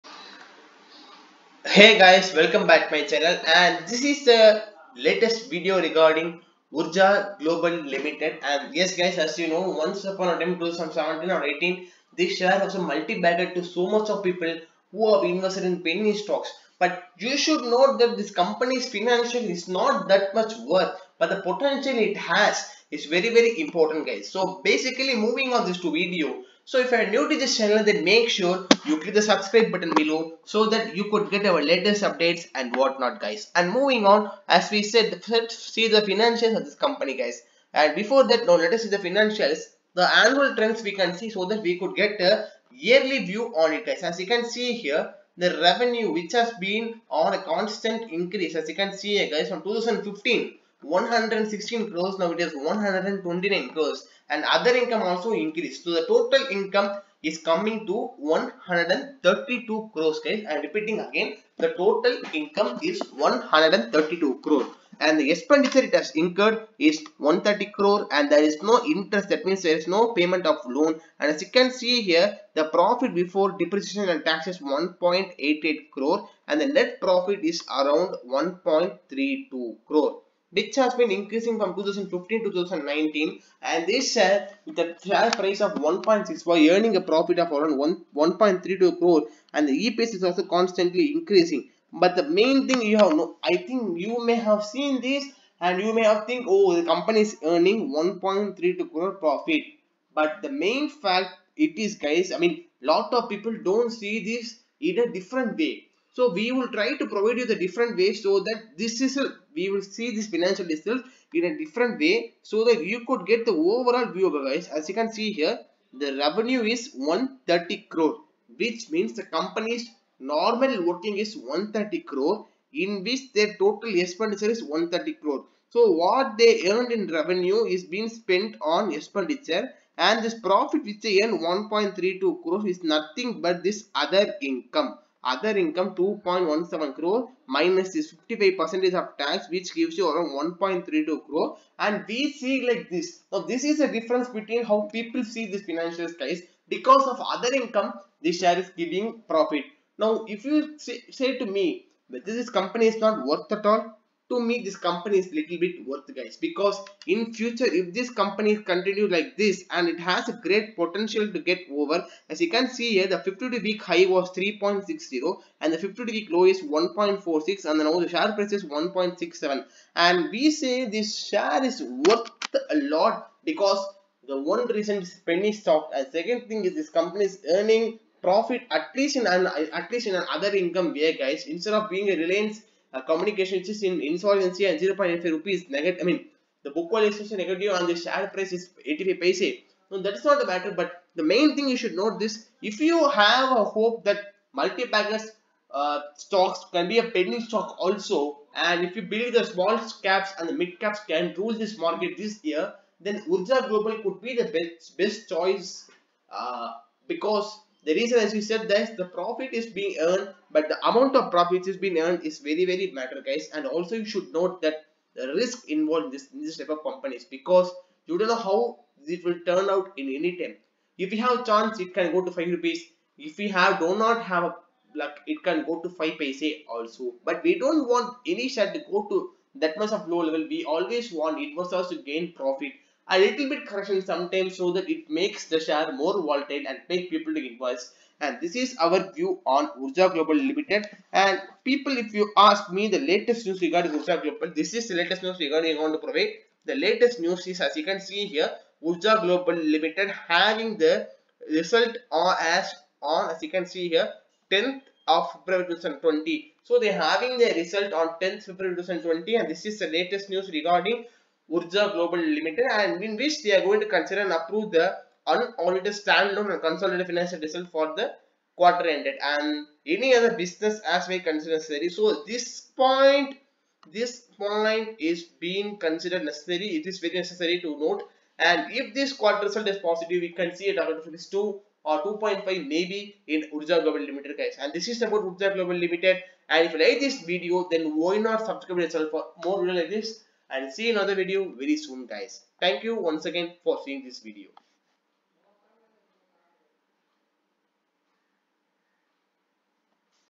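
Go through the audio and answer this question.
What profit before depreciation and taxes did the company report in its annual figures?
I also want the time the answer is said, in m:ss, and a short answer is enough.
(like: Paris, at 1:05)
1.88 crore, at 1:14.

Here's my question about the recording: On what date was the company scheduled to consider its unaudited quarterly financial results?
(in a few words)
10 February 2020.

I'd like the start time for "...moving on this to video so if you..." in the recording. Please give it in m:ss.
0:25.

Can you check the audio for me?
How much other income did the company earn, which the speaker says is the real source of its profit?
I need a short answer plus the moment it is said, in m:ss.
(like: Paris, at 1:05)
2.17 crore, at 2:15.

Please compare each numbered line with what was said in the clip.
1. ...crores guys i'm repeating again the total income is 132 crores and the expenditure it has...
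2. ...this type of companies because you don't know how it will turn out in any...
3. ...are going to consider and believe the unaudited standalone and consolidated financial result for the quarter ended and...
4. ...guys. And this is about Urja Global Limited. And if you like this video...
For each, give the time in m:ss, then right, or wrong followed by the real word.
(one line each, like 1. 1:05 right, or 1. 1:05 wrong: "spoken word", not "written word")
1. 0:59 right
2. 3:36 right
3. 4:23 wrong: "approve", not "believe"
4. 4:44 right.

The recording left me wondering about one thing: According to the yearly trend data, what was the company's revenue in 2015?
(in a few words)
116 crores.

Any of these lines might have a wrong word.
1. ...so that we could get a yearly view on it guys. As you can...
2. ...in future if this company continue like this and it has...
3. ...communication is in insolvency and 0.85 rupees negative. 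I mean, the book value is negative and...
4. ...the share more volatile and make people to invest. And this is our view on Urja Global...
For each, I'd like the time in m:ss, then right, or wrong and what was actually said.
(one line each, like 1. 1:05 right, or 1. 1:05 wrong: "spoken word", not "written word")
1. 0:41 right
2. 2:37 right
3. 3:03 right
4. 3:55 right.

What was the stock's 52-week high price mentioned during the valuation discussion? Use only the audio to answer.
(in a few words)
3.60.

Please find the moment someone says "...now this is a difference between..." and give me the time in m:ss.
2:23.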